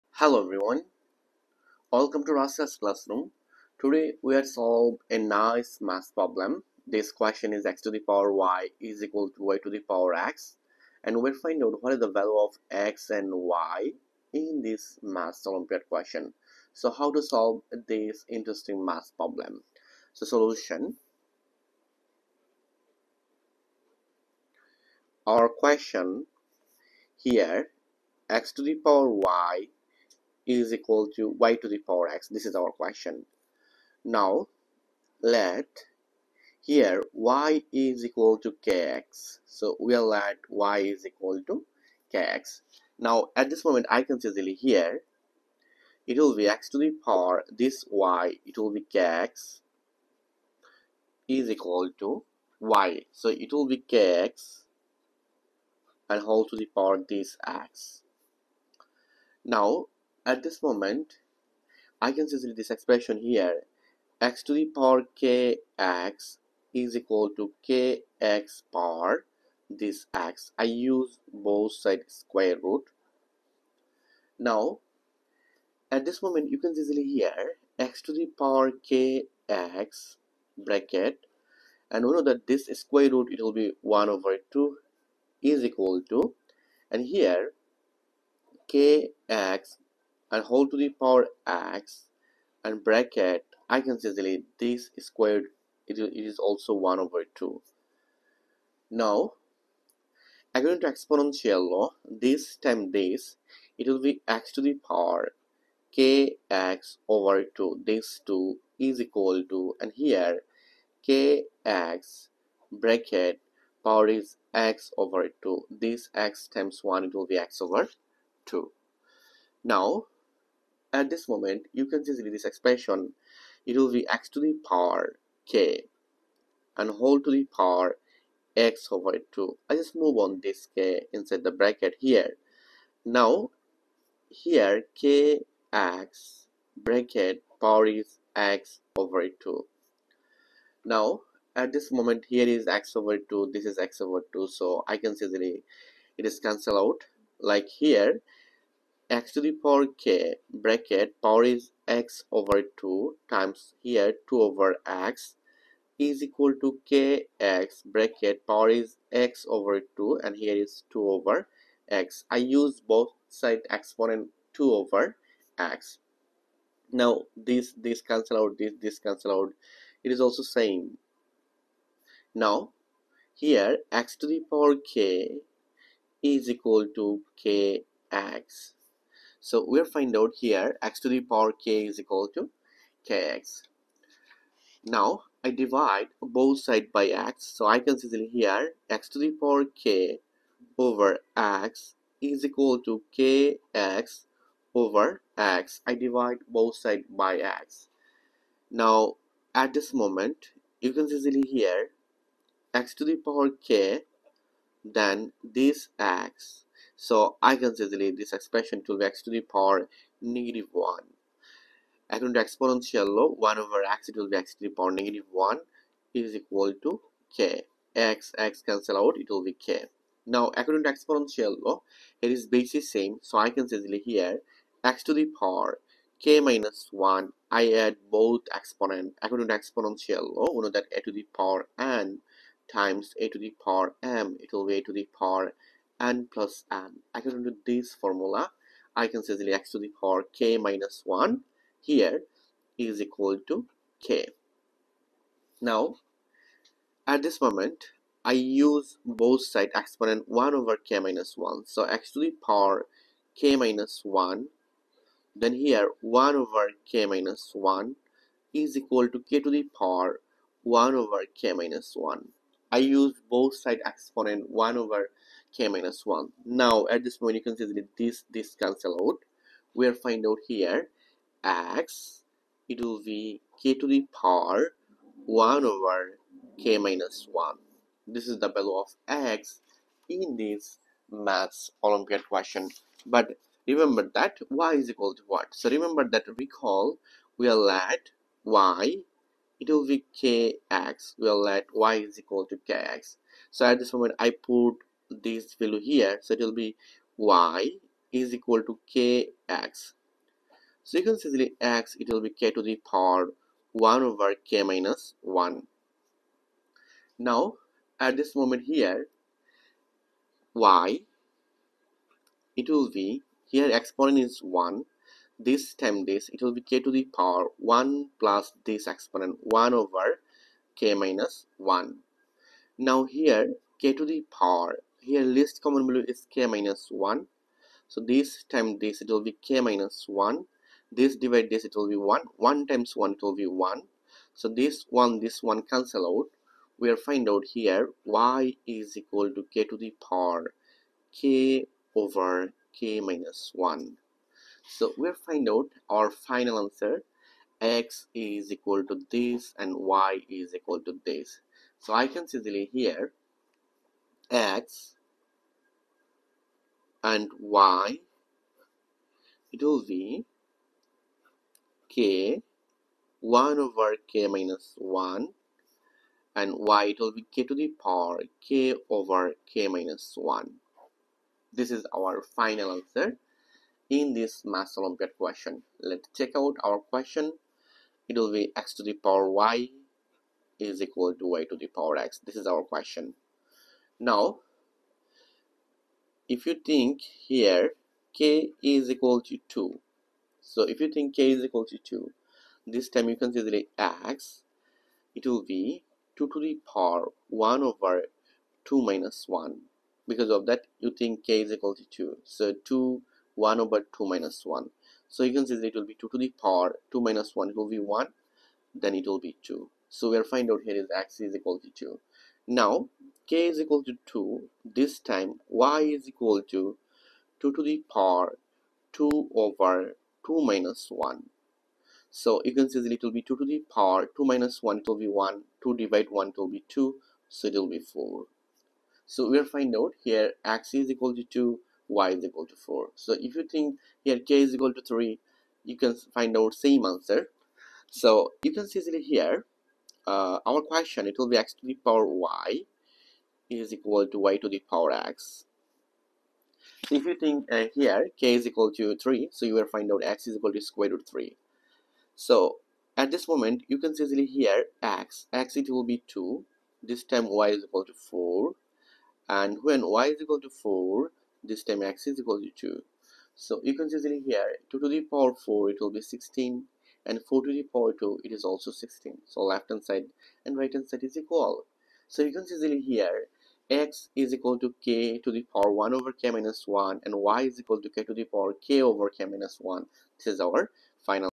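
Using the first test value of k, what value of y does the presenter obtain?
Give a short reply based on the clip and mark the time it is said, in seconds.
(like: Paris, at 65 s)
4, at 427 s.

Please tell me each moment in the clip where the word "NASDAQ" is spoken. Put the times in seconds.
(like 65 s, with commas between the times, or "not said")
not said.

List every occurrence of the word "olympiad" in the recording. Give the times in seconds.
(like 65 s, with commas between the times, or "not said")
15 s, 281 s, 374 s.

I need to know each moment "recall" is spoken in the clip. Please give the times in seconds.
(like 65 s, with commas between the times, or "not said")
286 s.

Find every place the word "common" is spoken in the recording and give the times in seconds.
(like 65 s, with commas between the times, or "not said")
325 s.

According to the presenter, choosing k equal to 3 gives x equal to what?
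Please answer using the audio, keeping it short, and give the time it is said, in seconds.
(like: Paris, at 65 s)
square root 3, at 450 s.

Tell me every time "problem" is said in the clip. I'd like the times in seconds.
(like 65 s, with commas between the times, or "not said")
6 s, 19 s.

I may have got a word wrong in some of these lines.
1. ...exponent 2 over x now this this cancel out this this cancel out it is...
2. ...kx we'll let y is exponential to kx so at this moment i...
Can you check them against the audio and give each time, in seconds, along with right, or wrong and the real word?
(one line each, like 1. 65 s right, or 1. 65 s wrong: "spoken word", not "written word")
1. 163 s right
2. 290 s wrong: "equal", not "exponential".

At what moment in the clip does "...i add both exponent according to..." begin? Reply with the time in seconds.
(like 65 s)
227 s.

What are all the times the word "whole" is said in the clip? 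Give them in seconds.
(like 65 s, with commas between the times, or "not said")
56 s, 126 s.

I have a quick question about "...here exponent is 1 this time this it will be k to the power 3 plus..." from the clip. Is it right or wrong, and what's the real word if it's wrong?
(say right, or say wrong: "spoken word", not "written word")
wrong: "1", not "3".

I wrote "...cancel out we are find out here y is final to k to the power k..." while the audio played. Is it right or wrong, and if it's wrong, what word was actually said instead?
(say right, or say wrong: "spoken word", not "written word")
wrong: "equal", not "final".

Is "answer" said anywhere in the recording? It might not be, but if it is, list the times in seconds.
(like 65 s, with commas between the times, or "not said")
346 s, 372 s, 436 s.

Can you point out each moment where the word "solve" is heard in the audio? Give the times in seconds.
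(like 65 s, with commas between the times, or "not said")
4 s, 17 s.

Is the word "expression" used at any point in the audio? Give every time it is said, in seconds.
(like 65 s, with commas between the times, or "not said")
62 s, 122 s, 208 s.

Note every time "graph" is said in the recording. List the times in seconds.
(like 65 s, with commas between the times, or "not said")
not said.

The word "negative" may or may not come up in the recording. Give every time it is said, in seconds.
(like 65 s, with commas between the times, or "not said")
210 s, 214 s.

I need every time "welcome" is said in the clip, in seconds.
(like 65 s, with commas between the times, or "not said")
1 s.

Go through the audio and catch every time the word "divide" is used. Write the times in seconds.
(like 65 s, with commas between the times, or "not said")
185 s, 195 s, 331 s, 425 s.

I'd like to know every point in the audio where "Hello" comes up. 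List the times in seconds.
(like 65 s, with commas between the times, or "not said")
0 s.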